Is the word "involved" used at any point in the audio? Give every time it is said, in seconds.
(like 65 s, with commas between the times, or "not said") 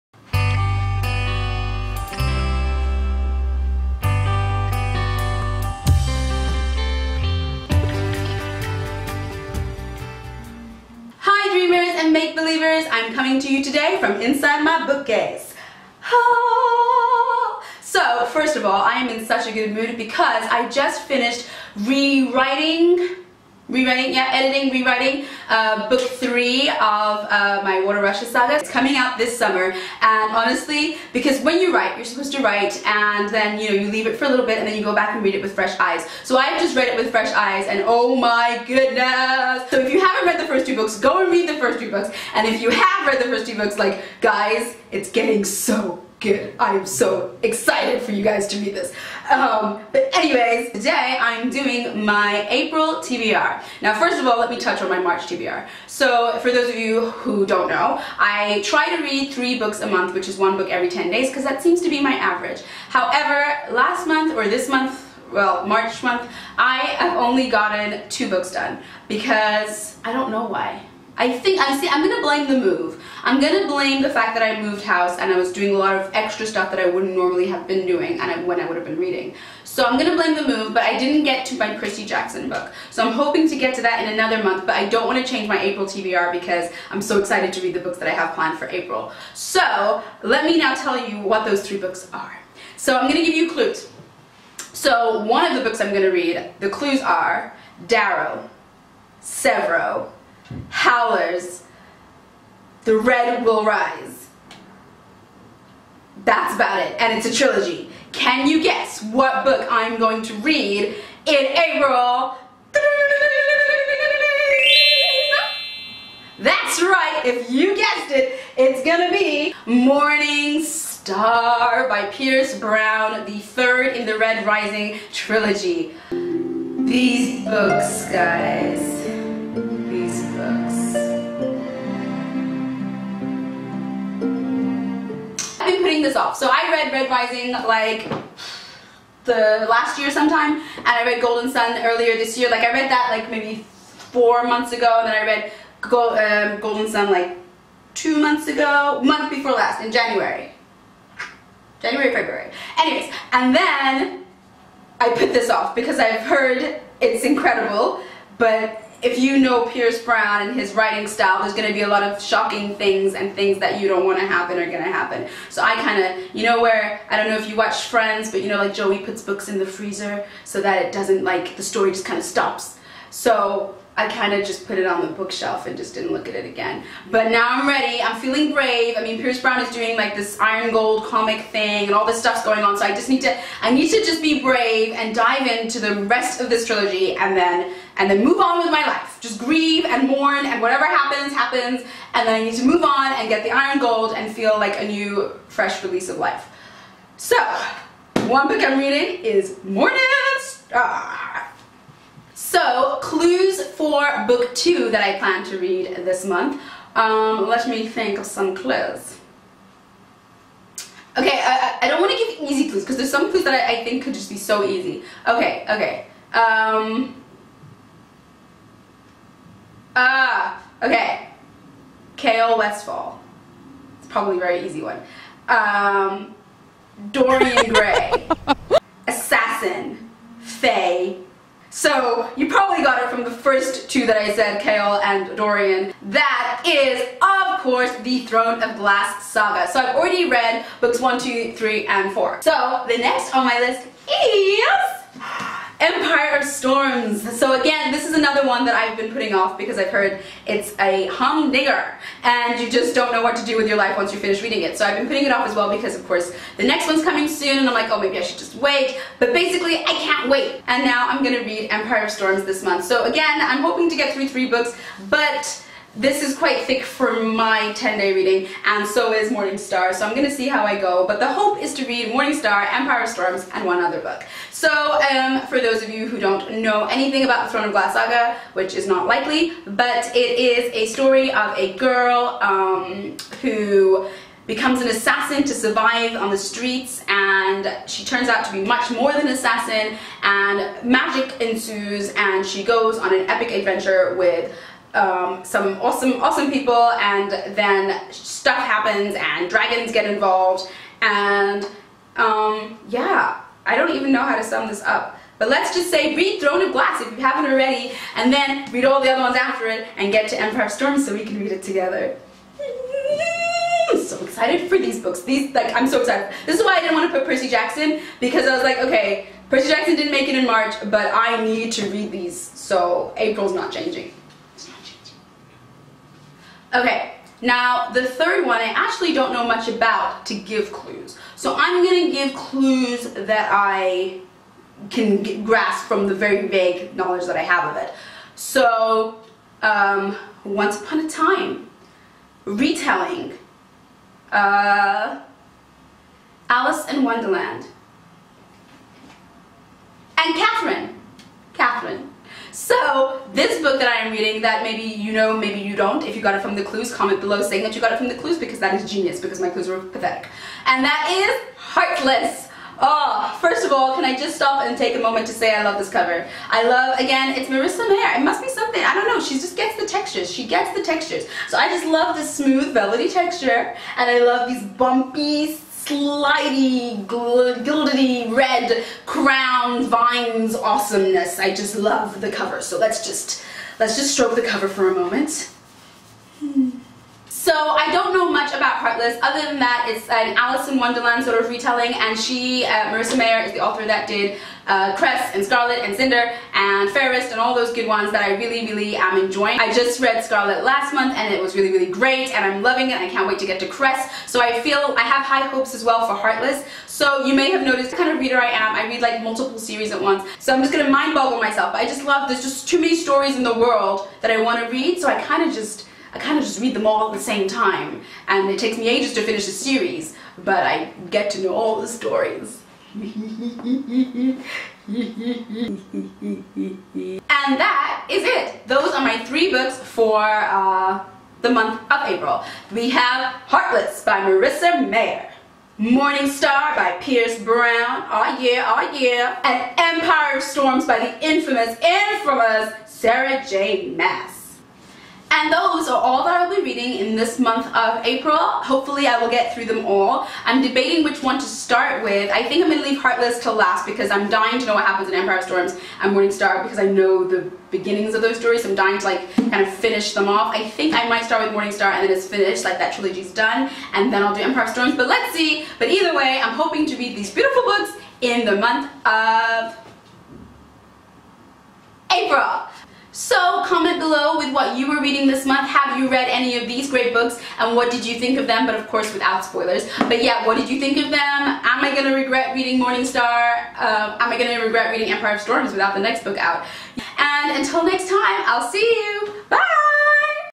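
300 s.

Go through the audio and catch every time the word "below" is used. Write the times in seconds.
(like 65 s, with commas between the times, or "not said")
357 s, 473 s.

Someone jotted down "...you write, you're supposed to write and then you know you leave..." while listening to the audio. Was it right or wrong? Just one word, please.
right.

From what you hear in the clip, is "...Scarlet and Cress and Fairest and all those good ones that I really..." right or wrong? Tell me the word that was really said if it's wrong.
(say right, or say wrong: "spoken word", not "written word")
wrong: "Cinder", not "Cress".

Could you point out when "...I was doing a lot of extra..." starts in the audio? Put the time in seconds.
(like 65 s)
75 s.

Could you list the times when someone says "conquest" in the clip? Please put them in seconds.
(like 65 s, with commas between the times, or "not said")
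not said.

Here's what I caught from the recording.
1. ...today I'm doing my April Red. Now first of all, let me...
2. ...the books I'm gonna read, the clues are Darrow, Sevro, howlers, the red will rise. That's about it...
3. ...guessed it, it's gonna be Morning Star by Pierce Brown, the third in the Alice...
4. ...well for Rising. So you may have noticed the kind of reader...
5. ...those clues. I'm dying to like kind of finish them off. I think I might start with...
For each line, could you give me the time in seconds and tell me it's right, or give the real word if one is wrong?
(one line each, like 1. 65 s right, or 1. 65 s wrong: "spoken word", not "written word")
1. 50 s wrong: "TBR", not "Red"
2. 95 s right
3. 117 s wrong: "Red", not "Alice"
4. 405 s wrong: "Heartless", not "Rising"
5. 458 s wrong: "stories", not "clues".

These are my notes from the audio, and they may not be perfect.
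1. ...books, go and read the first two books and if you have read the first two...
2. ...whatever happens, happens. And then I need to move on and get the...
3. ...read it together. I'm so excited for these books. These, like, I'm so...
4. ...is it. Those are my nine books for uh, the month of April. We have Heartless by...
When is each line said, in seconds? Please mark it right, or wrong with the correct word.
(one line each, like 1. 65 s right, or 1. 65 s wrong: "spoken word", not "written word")
1. 40 s right
2. 190 s right
3. 311 s right
4. 428 s wrong: "three", not "nine".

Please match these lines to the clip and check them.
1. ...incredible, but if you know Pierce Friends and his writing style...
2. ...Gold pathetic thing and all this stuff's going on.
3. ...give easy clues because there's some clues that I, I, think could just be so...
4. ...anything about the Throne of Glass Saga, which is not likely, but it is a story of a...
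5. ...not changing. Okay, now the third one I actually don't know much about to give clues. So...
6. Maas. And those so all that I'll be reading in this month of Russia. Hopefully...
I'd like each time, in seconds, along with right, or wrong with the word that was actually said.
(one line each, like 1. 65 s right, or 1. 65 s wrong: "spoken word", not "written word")
1. 157 s wrong: "Brown", not "Friends"
2. 180 s wrong: "comic", not "pathetic"
3. 212 s right
4. 276 s right
5. 323 s right
6. 443 s wrong: "April", not "Russia".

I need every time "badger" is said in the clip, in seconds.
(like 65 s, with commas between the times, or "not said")
not said.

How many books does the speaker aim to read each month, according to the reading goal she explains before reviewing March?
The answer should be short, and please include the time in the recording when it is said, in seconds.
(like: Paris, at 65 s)
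3, at 59 s.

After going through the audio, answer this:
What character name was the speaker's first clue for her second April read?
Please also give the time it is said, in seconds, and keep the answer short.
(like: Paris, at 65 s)
Chaol Westfall, at 222 s.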